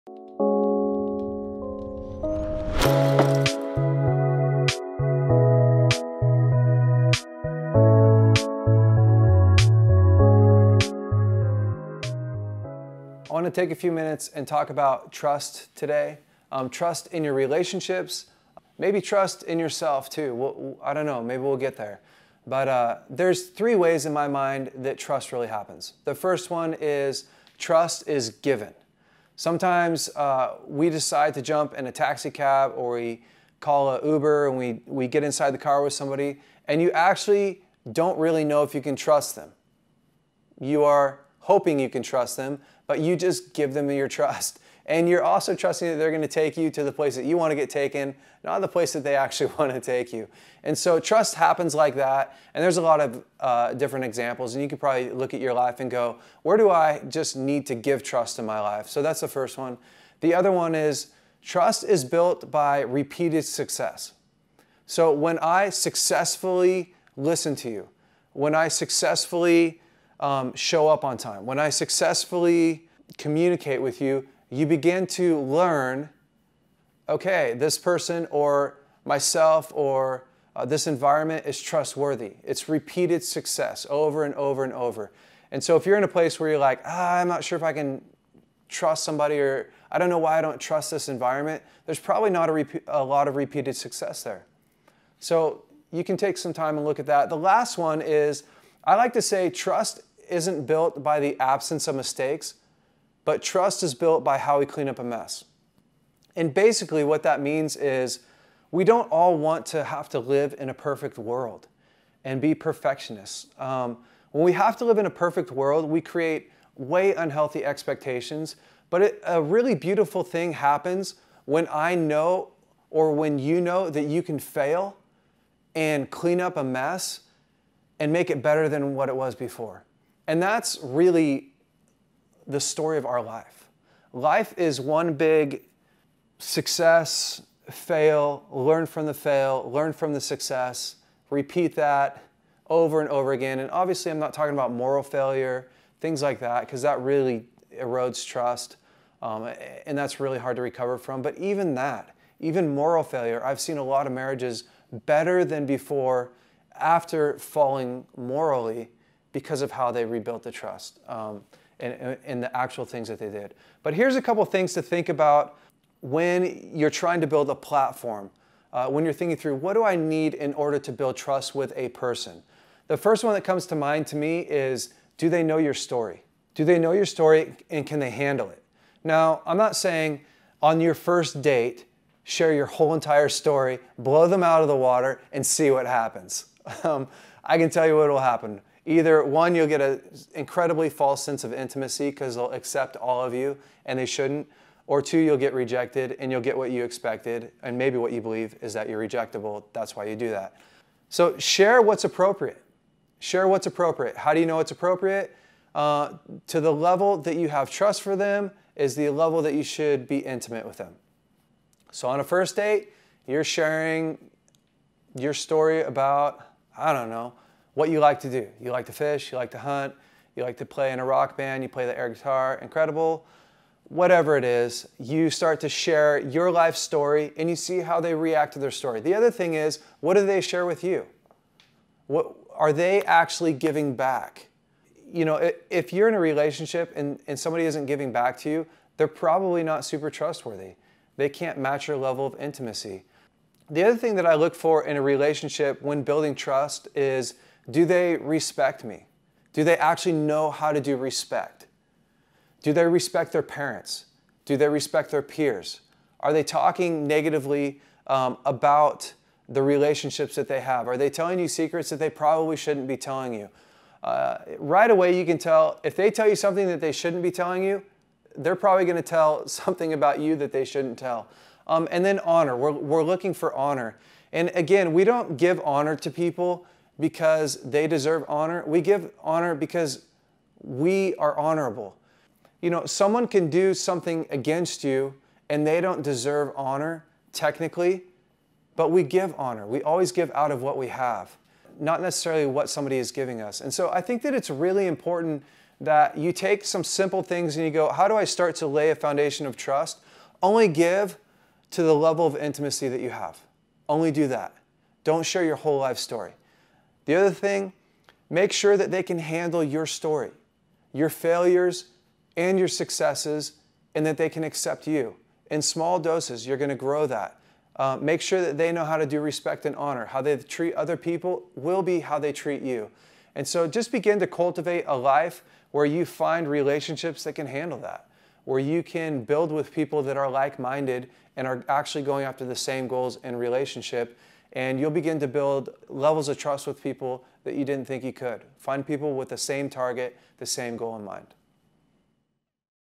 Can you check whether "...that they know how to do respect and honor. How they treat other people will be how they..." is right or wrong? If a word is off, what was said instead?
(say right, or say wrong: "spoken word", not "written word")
right.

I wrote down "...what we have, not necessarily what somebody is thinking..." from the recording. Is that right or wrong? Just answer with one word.
wrong.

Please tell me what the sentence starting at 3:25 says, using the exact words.
Uh, to the level that you have trust for them is the level that you should be intimate with them.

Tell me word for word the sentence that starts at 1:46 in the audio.
And basically, what that means is we don't all want to have to live in a perfect world and be perfectionists.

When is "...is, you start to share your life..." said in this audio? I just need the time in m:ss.
3:44.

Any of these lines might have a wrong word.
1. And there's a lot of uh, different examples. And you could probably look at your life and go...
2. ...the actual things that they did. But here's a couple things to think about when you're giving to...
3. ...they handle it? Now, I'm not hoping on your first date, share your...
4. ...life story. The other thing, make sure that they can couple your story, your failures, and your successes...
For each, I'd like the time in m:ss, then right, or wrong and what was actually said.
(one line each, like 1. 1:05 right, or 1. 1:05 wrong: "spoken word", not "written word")
1. 0:52 right
2. 2:42 wrong: "trying", not "giving"
3. 2:57 wrong: "saying", not "hoping"
4. 5:05 wrong: "handle", not "couple".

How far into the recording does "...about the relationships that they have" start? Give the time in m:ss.
4:18.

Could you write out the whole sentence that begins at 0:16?
Um, trust in your relationships, maybe trust in yourself too.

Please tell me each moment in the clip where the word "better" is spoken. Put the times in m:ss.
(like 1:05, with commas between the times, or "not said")
2:08, 2:35.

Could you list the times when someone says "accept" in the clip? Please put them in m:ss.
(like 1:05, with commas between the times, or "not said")
3:12, 5:14.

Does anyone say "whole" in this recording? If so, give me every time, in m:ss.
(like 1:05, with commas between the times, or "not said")
3:02, 5:05.